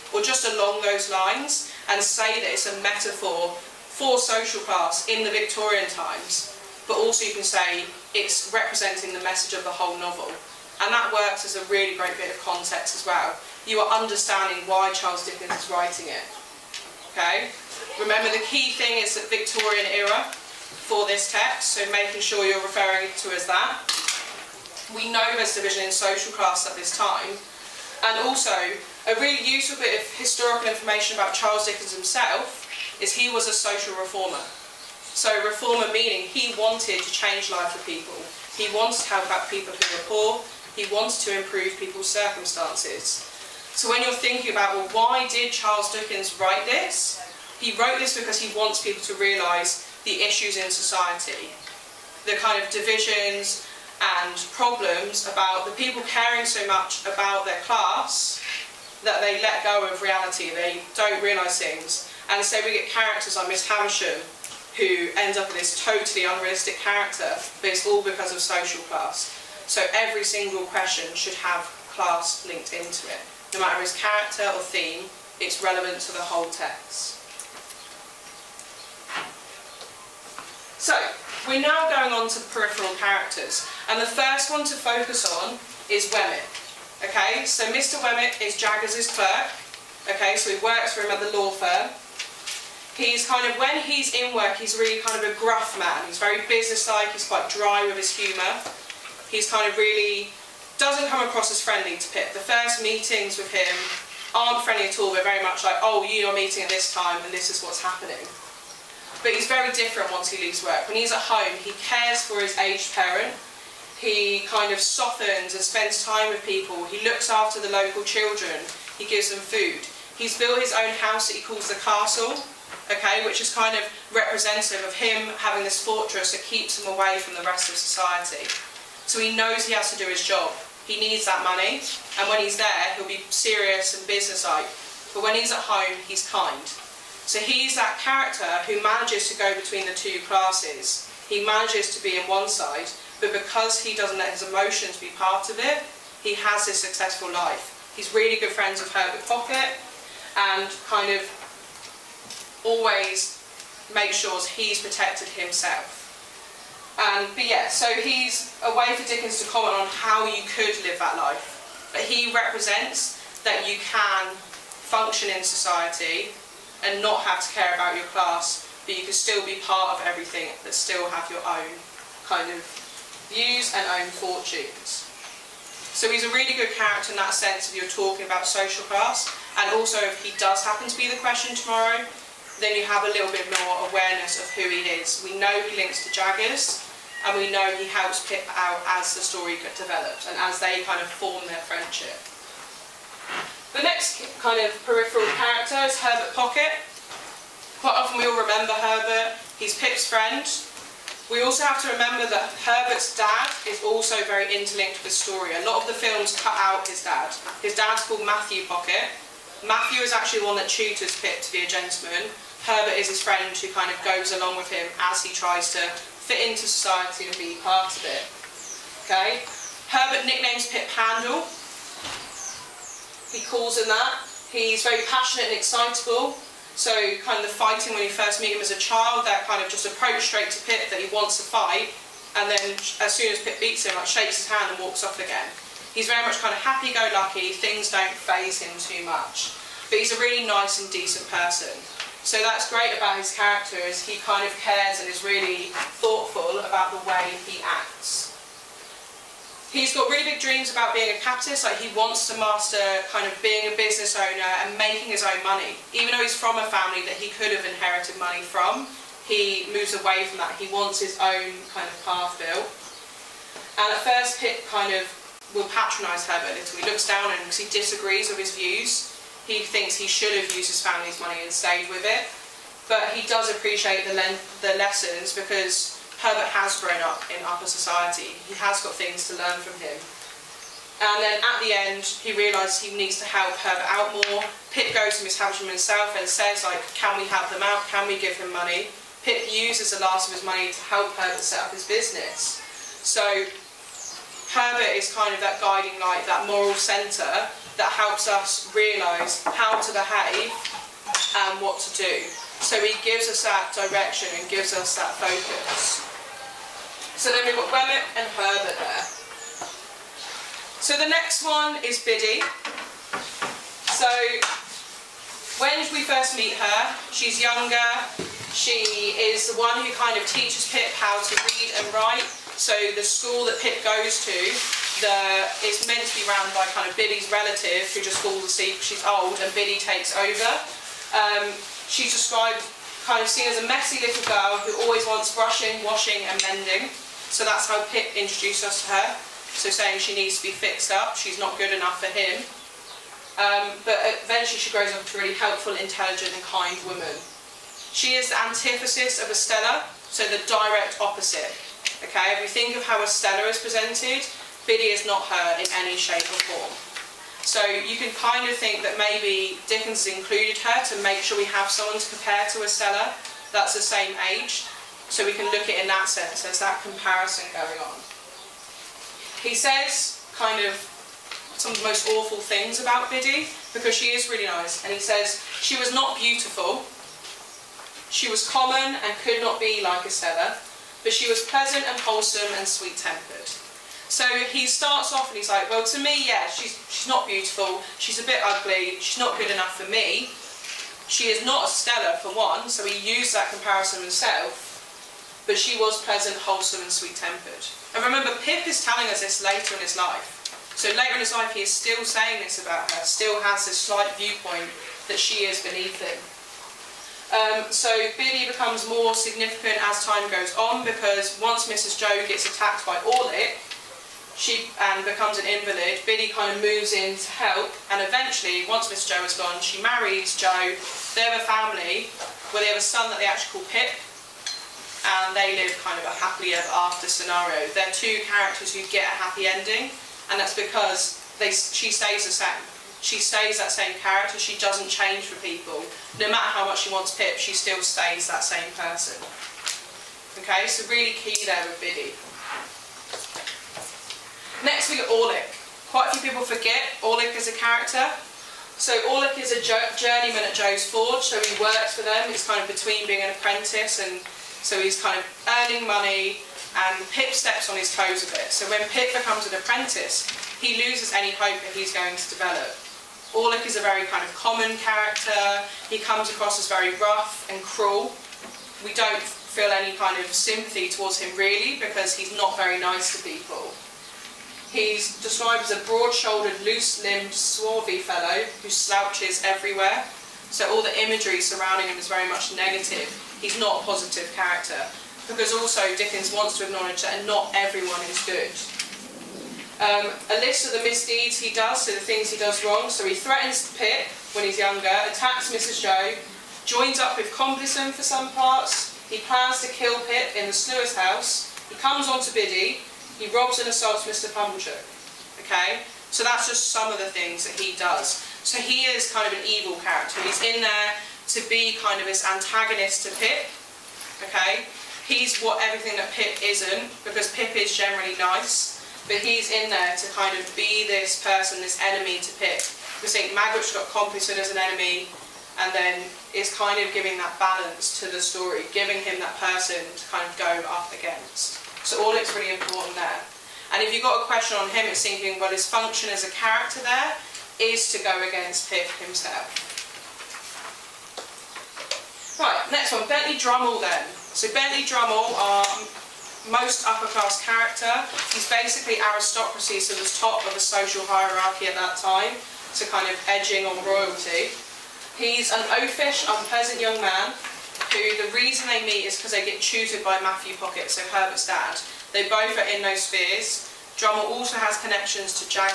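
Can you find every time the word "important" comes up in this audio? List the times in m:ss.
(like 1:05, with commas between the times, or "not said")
8:52.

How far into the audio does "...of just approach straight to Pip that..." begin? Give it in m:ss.
3:49.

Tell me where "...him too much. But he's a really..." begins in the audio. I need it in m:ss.
3:58.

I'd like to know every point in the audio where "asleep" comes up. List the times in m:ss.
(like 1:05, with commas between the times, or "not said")
5:28.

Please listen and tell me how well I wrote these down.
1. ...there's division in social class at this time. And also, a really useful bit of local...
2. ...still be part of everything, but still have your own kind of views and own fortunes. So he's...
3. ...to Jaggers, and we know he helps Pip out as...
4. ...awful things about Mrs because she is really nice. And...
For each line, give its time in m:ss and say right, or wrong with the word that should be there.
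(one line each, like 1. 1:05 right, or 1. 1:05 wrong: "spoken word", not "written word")
1. 0:25 wrong: "historical", not "local"
2. 2:49 right
3. 3:06 right
4. 6:12 wrong: "Biddy", not "Mrs".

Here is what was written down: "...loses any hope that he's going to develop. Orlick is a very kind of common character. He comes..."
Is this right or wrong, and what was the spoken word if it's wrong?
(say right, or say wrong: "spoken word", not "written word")
right.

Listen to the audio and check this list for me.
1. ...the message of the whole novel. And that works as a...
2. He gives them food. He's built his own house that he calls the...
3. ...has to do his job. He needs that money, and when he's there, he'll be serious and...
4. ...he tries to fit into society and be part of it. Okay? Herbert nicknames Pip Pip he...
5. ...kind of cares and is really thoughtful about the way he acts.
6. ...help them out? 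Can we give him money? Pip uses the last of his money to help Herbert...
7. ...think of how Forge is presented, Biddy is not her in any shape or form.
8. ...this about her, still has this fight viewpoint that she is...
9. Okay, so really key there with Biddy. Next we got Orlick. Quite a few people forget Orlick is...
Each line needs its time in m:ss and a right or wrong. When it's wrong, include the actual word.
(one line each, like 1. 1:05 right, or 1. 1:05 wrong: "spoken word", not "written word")
1. 0:09 right
2. 1:58 right
3. 2:09 right
4. 3:35 wrong: "Handel", not "Pip"
5. 4:04 right
6. 4:47 right
7. 5:52 wrong: "Estella", not "Forge"
8. 6:42 wrong: "slight", not "fight"
9. 7:20 right.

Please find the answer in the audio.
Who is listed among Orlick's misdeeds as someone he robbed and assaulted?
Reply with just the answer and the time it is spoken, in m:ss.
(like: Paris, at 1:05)
Mr. 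Pumblechook, at 8:24.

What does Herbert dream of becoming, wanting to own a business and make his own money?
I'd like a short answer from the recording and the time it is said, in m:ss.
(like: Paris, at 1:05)
Capitalist, at 4:11.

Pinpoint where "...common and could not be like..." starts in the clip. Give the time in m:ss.
6:18.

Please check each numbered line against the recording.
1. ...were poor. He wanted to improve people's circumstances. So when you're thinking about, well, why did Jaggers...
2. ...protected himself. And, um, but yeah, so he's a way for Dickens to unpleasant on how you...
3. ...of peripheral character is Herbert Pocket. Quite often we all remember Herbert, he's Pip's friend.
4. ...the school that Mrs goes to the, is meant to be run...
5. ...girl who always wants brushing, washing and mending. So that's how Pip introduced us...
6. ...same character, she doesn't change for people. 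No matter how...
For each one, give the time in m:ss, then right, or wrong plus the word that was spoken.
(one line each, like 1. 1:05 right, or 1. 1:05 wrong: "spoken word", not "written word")
1. 0:39 wrong: "Charles", not "Jaggers"
2. 2:34 wrong: "comment", not "unpleasant"
3. 3:14 right
4. 5:22 wrong: "Pip", not "Mrs"
5. 5:34 right
6. 7:13 right.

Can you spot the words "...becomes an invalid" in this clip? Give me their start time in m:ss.
6:55.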